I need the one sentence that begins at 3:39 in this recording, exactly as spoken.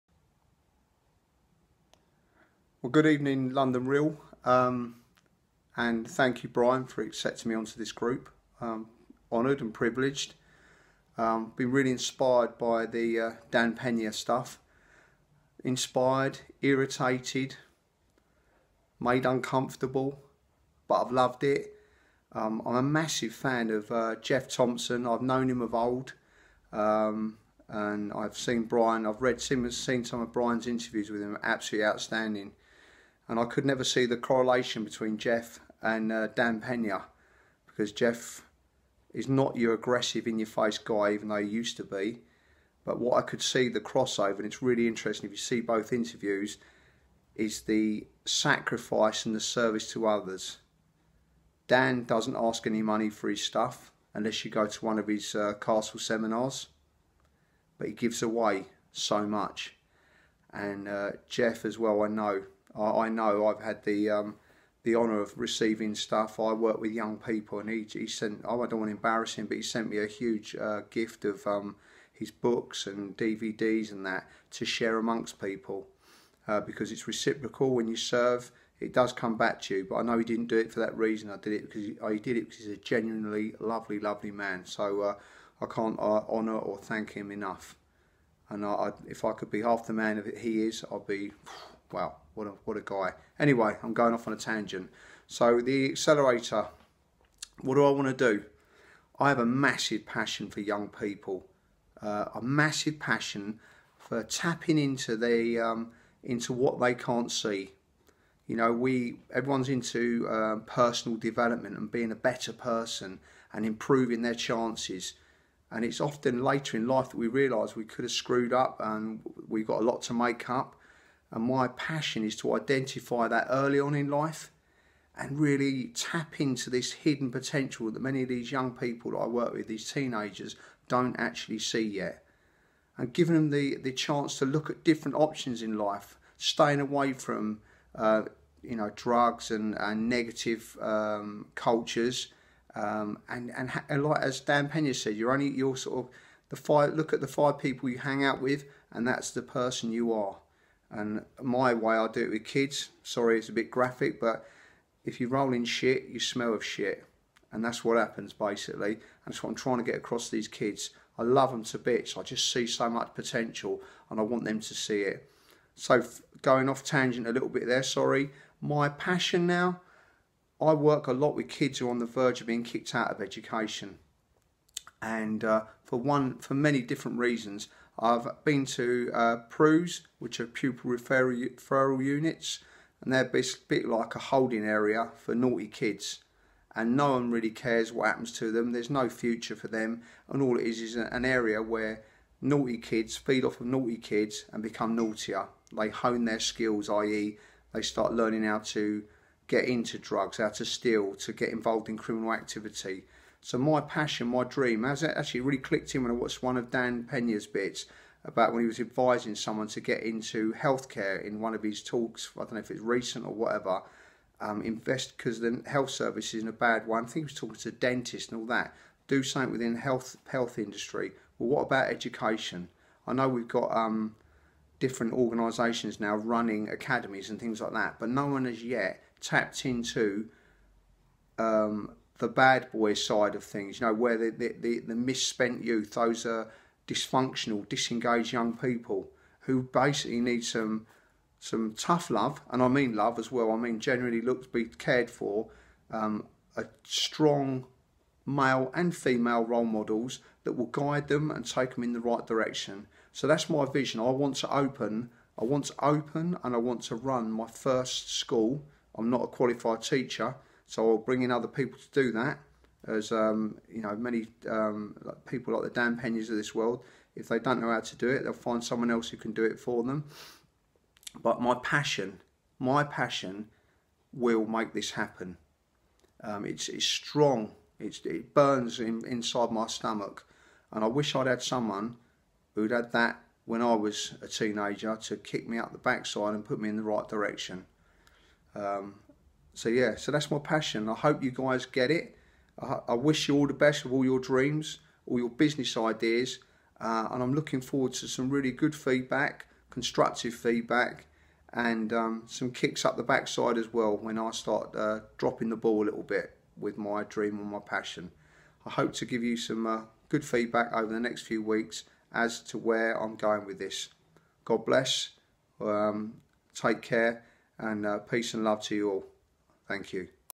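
Do something within health health industry.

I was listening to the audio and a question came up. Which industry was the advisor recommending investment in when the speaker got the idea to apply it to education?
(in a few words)
Healthcare.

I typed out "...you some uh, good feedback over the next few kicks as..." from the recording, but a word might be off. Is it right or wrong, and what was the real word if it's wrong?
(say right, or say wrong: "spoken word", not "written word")
wrong: "weeks", not "kicks".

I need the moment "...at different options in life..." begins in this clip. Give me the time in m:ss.
2:14.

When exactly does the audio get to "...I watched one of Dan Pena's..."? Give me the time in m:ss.
3:26.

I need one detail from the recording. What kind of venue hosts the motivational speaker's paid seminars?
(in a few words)
Castle.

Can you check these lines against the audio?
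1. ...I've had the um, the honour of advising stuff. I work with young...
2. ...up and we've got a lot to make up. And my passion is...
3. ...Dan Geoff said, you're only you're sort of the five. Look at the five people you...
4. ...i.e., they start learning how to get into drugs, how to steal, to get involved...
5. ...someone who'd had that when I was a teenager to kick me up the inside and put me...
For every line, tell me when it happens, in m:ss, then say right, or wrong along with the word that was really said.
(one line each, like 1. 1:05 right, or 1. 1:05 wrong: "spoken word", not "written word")
1. 1:03 wrong: "receiving", not "advising"
2. 1:58 right
3. 2:24 wrong: "Pena", not "Geoff"
4. 3:16 right
5. 4:41 wrong: "backside", not "inside".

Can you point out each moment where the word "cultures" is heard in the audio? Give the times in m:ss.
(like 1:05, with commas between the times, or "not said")
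2:21.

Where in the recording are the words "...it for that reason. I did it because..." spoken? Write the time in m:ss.
1:20.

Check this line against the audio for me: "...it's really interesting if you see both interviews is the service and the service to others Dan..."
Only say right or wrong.
wrong.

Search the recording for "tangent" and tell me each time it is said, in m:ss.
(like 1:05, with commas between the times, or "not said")
1:34, 2:46.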